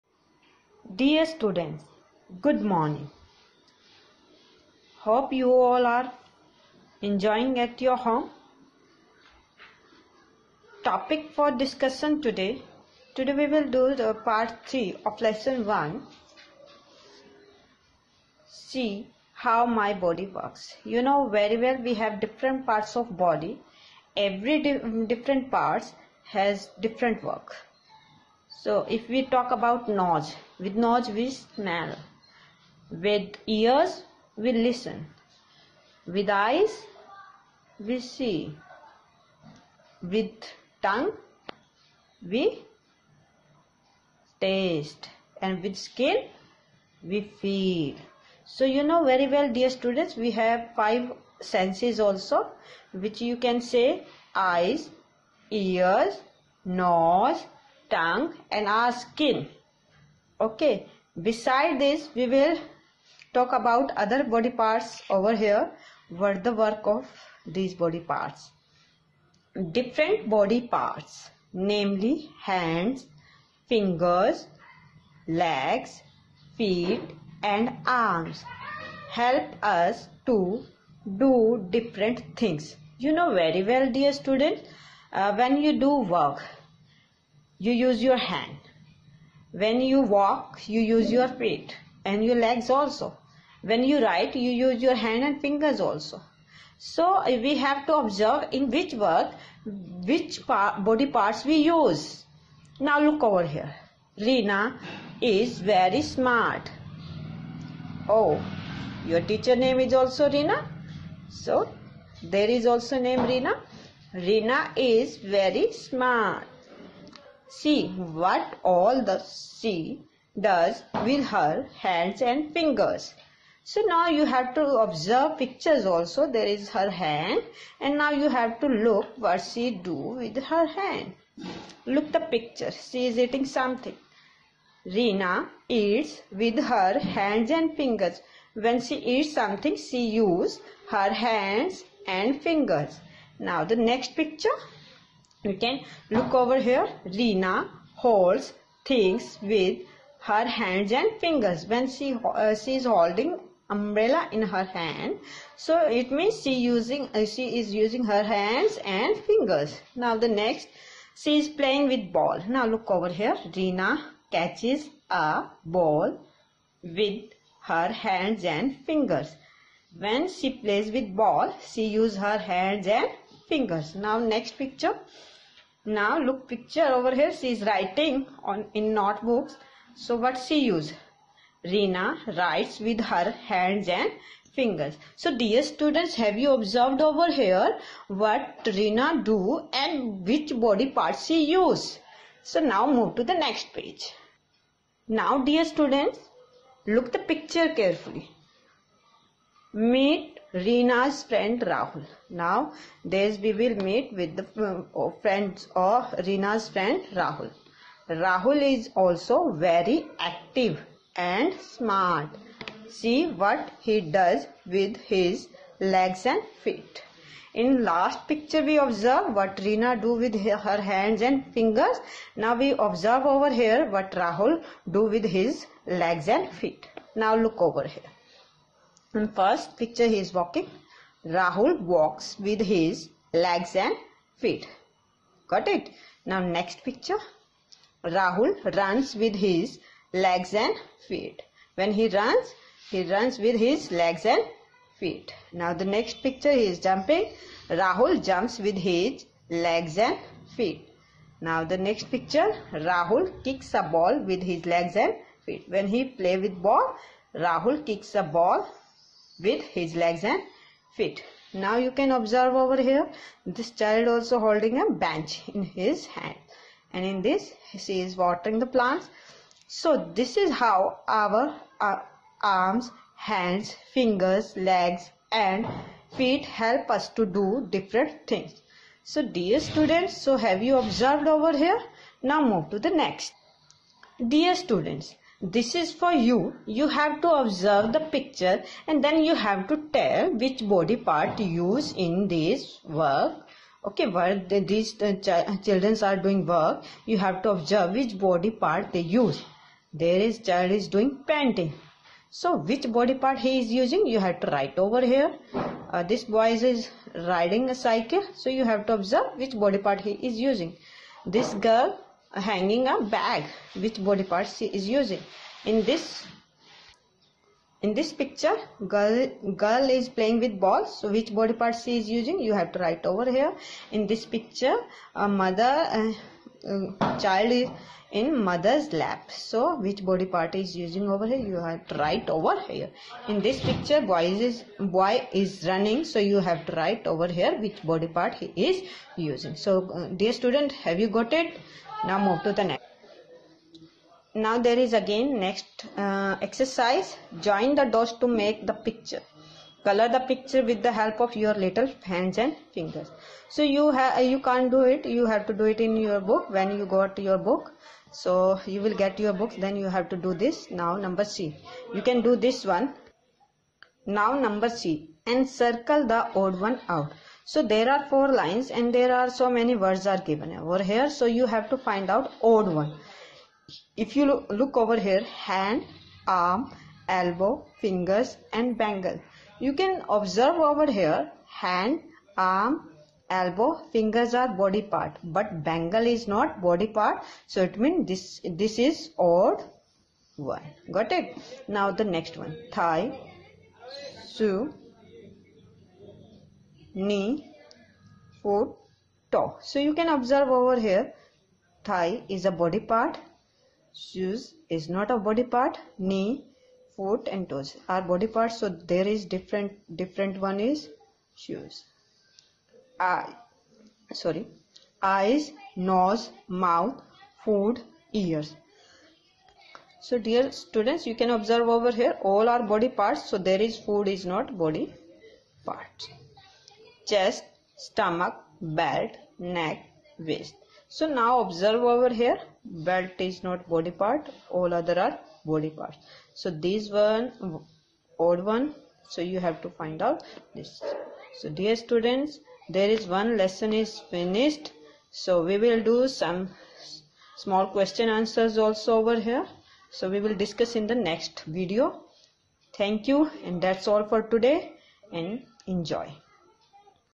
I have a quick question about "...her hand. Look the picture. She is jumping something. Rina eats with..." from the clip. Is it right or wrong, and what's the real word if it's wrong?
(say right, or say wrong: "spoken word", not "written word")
wrong: "eating", not "jumping".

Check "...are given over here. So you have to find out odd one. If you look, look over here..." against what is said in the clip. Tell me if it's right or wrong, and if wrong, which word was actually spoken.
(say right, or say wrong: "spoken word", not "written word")
right.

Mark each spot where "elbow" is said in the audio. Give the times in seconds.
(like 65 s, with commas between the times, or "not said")
377 s, 383 s.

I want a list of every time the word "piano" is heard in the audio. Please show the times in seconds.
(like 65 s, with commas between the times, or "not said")
not said.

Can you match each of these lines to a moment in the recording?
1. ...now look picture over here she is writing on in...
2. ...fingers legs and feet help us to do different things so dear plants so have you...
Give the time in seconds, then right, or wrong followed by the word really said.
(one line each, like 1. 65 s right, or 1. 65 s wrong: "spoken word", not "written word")
1. 175 s right
2. 273 s wrong: "students", not "plants".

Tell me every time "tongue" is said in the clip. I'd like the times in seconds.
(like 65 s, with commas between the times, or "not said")
40 s, 57 s.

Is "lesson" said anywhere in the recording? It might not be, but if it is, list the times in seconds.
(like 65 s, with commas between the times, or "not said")
15 s, 443 s.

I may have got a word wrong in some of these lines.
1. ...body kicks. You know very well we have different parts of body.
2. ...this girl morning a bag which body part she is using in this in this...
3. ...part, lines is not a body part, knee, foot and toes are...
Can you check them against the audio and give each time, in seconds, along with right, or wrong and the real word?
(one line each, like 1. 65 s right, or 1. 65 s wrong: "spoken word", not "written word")
1. 19 s wrong: "works", not "kicks"
2. 311 s wrong: "hanging", not "morning"
3. 402 s wrong: "shoes", not "lines".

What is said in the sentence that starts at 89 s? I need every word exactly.
When you walk, you use your feet and your legs also.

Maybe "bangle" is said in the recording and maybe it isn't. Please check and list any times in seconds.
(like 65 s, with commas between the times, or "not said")
378 s, 385 s.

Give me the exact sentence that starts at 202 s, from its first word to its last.
Now, this we will meet with the uh, friends of Rina's friend Rahul.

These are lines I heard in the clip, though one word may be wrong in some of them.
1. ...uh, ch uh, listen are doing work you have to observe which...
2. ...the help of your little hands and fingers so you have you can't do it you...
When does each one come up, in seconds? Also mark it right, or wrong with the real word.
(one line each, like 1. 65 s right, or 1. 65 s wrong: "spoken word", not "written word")
1. 295 s wrong: "children", not "listen"
2. 350 s right.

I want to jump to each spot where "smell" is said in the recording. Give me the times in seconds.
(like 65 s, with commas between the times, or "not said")
31 s.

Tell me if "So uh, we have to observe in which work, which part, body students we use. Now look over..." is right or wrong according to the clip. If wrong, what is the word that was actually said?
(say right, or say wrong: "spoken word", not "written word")
wrong: "parts", not "students".